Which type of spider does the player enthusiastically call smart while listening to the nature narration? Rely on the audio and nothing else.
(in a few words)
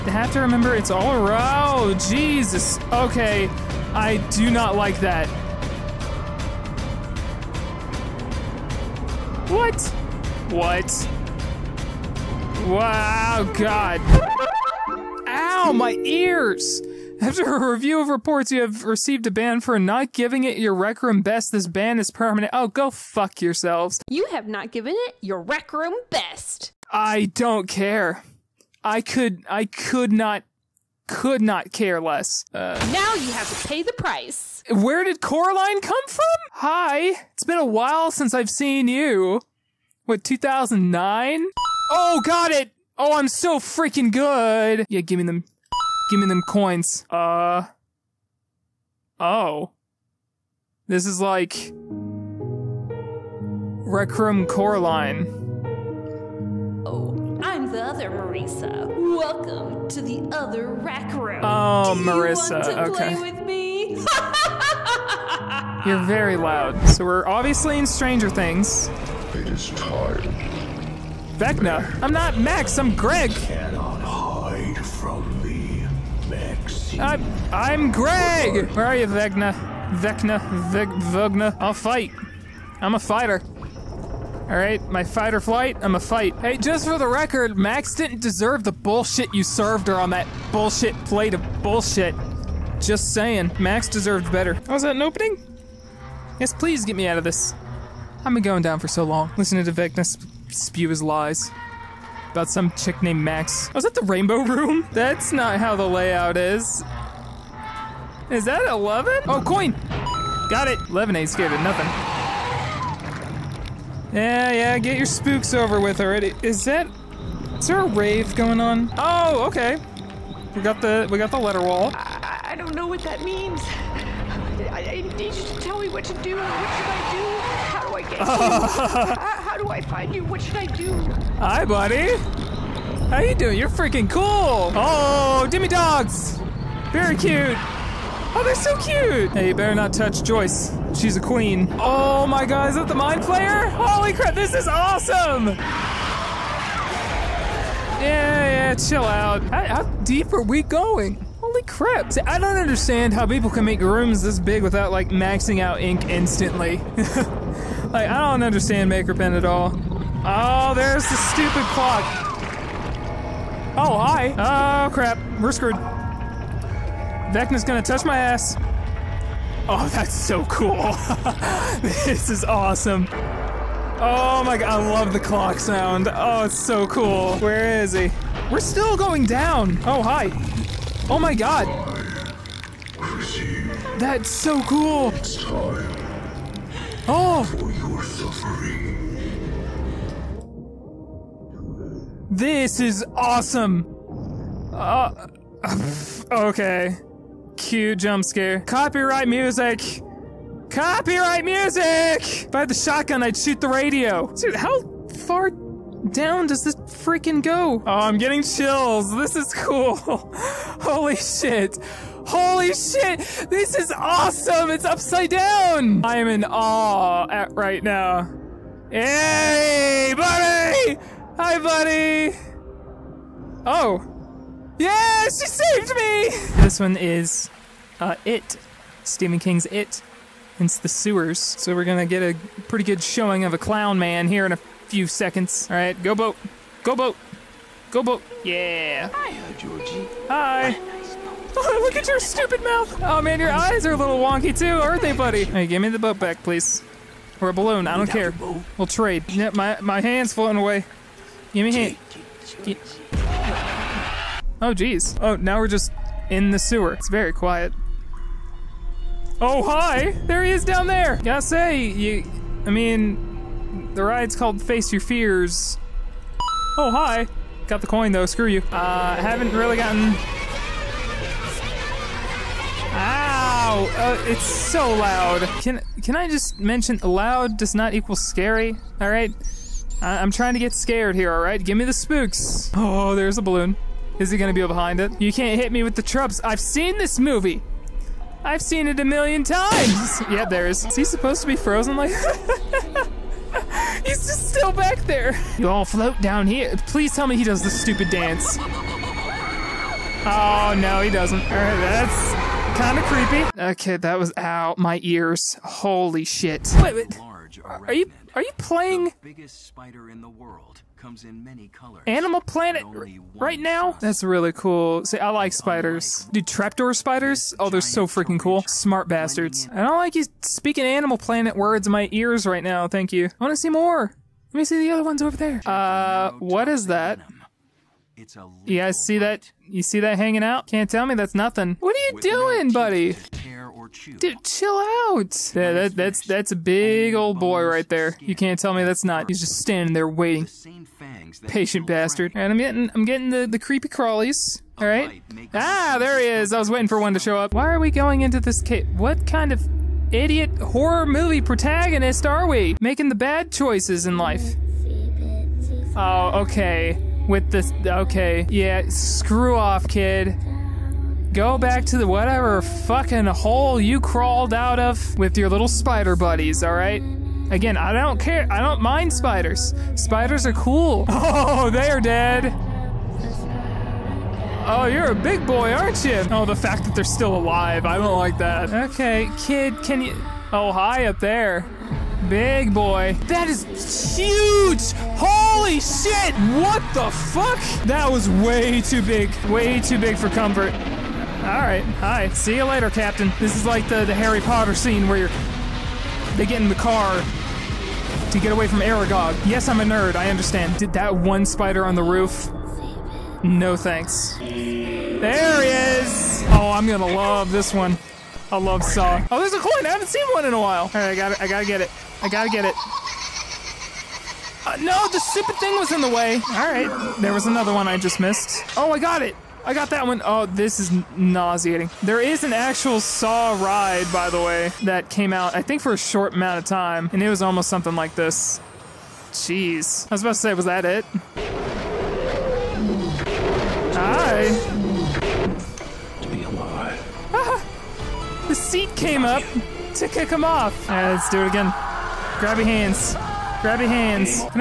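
trapdoor spiders.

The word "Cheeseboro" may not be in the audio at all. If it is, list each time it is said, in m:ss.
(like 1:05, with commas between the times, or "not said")
not said.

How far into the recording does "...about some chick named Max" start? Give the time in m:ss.
1:42.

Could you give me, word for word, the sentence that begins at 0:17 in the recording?
After a review of reports, you have received a ban for not giving it your rec room best.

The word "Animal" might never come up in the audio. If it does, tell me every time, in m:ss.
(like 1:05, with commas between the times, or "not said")
5:12, 5:20.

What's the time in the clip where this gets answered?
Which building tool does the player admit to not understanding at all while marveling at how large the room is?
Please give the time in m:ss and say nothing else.
2:38.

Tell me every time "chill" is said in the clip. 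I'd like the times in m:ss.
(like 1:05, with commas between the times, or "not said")
2:28, 3:28, 5:34.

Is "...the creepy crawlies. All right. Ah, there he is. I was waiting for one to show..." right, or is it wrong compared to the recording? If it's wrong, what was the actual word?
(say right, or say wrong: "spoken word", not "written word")
right.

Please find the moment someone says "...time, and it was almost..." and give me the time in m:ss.
7:06.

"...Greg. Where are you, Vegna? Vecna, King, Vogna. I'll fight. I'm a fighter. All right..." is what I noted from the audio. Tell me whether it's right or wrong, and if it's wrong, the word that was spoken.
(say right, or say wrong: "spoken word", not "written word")
wrong: "Veg", not "King".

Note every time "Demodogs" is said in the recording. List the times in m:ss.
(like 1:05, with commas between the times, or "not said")
2:15.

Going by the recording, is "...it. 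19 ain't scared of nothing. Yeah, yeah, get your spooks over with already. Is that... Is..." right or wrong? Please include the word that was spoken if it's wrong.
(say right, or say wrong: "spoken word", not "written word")
wrong: "11", not "19".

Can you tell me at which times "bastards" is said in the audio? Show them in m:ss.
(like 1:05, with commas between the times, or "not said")
5:19, 5:41.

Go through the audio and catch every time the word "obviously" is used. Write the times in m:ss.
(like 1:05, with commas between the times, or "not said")
1:07.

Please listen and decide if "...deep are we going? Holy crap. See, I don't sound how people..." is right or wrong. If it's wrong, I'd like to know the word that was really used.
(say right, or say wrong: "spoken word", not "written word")
wrong: "understand", not "sound".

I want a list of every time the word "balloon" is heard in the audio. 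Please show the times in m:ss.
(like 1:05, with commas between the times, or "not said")
4:07, 4:43.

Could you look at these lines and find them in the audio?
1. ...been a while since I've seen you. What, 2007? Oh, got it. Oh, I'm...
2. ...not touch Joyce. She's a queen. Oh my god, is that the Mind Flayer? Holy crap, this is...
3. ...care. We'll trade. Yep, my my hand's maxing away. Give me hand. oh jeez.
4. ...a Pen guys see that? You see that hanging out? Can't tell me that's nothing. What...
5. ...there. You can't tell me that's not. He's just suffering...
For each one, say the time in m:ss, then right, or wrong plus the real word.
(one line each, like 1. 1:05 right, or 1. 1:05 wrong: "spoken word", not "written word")
1. 0:37 wrong: "2009", not "2007"
2. 2:19 right
3. 4:08 wrong: "floating", not "maxing"
4. 5:28 wrong: "You", not "Pen"
5. 5:37 wrong: "standing", not "suffering".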